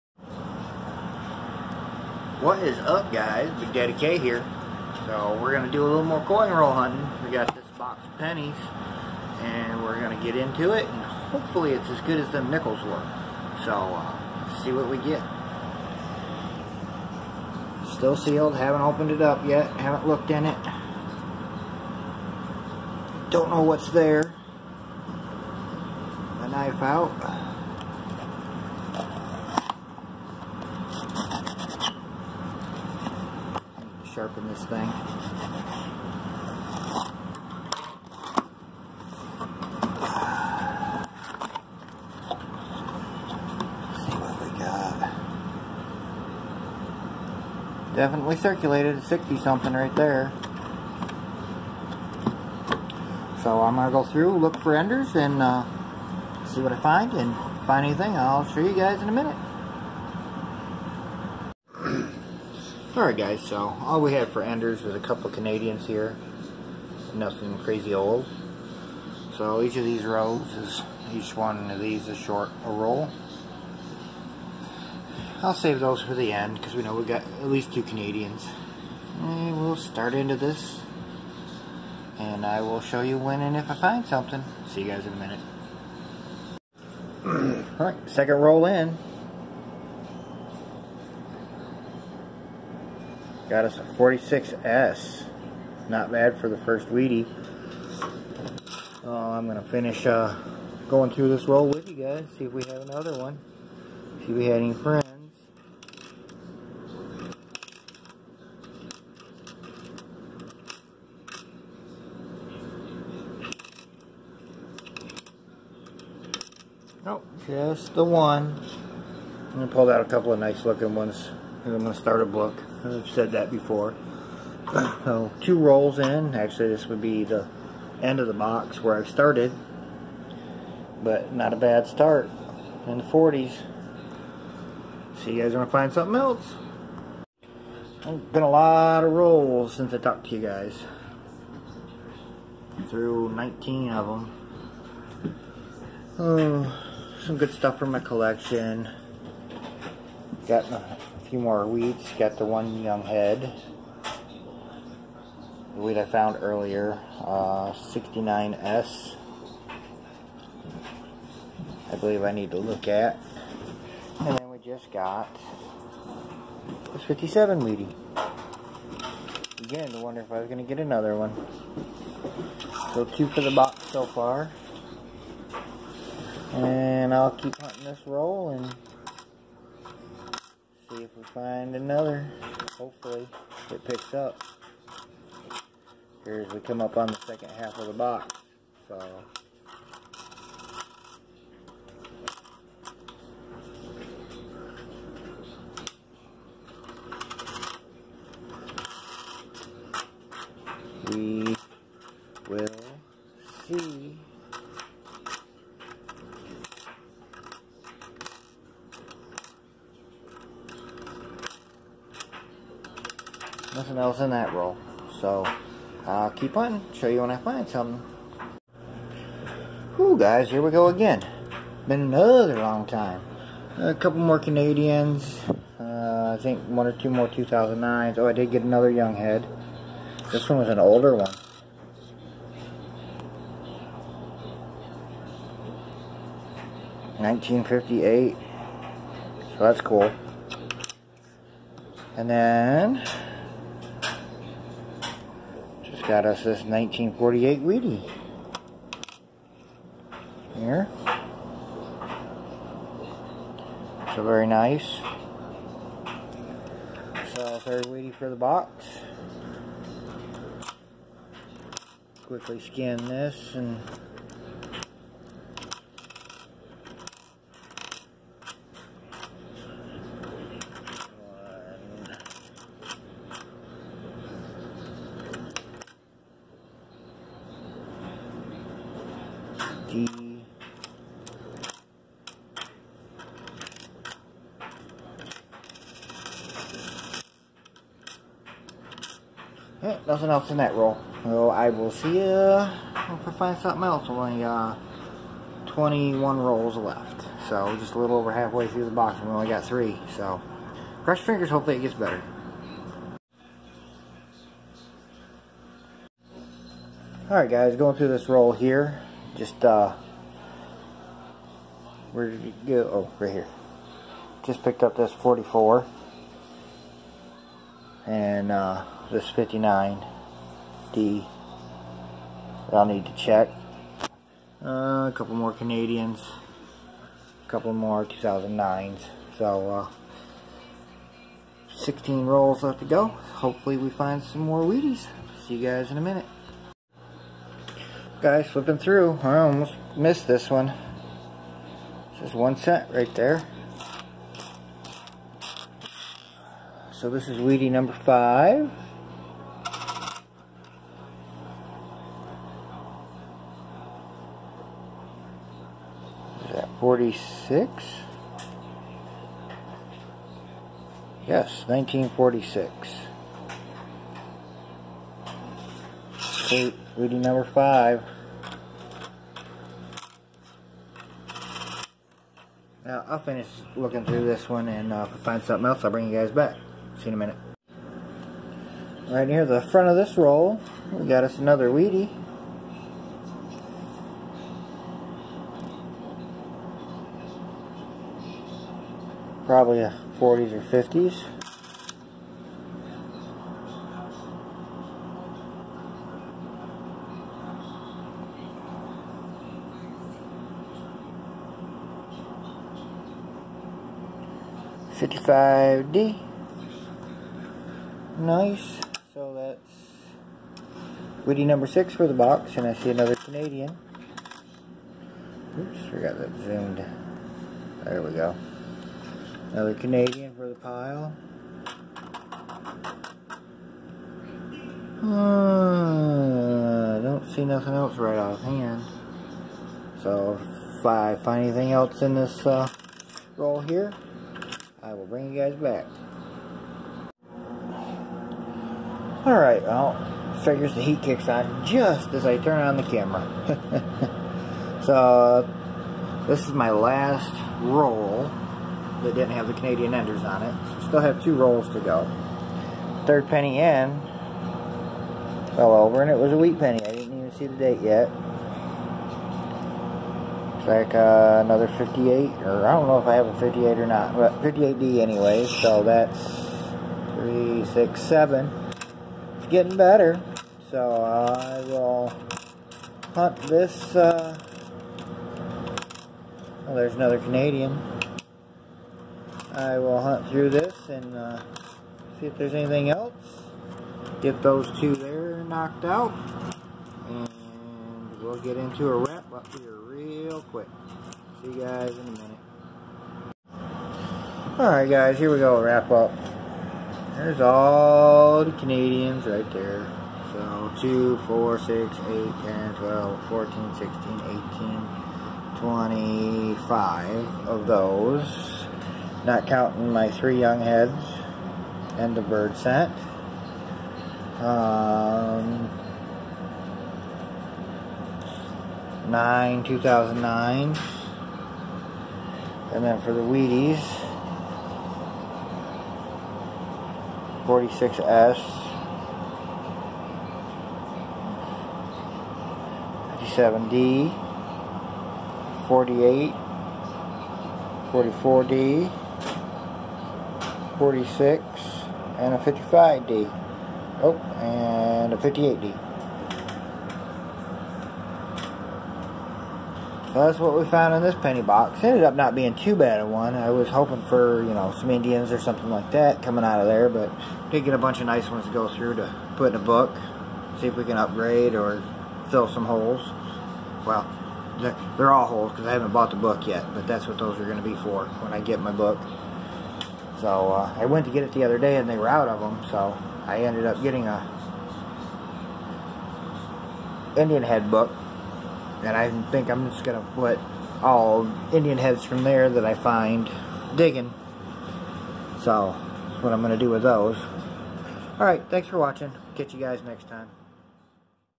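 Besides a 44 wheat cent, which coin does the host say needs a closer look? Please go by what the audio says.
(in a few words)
59D.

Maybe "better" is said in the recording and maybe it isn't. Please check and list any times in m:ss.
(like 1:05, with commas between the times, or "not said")
5:01, 7:49.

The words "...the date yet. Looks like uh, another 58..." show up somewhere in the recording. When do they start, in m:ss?
7:37.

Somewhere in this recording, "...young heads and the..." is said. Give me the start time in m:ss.
8:30.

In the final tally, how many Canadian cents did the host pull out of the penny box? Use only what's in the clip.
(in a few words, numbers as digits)
25.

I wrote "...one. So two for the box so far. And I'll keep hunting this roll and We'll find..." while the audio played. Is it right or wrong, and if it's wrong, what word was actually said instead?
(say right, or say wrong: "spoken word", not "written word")
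right.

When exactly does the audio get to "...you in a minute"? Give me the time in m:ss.
6:17.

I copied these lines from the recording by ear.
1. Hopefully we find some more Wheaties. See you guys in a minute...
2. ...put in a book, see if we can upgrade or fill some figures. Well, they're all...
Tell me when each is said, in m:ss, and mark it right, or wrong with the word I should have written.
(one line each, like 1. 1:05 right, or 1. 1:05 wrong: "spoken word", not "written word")
1. 5:33 right
2. 9:19 wrong: "holes", not "figures".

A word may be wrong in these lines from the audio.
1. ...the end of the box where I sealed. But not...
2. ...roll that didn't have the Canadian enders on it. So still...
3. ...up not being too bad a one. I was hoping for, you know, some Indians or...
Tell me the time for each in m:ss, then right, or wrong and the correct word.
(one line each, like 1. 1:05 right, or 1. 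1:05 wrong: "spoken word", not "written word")
1. 2:07 wrong: "started", not "sealed"
2. 7:27 right
3. 9:12 right.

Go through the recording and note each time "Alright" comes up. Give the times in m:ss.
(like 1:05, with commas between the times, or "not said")
1:02, 1:27, 5:07, 7:19, 8:14, 9:48.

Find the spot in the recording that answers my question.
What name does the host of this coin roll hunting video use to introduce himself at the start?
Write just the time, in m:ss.
0:03.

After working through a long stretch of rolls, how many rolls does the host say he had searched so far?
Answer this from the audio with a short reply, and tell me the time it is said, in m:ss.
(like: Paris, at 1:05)
19, at 2:23.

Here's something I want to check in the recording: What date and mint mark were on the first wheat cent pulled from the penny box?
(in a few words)
46S.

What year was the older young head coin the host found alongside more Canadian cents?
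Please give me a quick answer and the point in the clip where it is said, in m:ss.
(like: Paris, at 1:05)
1958, at 3:57.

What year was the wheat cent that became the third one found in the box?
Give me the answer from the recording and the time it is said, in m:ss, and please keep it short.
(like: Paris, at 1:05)
1948, at 4:06.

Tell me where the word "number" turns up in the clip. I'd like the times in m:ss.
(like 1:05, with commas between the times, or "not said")
5:47, 6:07, 6:51.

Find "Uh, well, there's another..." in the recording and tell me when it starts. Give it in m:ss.
7:53.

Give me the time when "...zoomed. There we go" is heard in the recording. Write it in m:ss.
6:56.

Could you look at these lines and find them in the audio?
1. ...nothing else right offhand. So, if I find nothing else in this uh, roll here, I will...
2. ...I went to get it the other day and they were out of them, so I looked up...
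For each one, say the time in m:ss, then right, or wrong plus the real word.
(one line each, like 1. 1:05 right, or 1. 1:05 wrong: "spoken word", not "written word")
1. 7:07 wrong: "anything", not "nothing"
2. 9:30 wrong: "ended", not "looked".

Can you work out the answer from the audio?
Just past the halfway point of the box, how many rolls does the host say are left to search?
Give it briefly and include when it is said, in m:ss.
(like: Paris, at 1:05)
21, at 4:55.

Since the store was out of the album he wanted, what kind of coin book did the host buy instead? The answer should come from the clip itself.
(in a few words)
Indian head book.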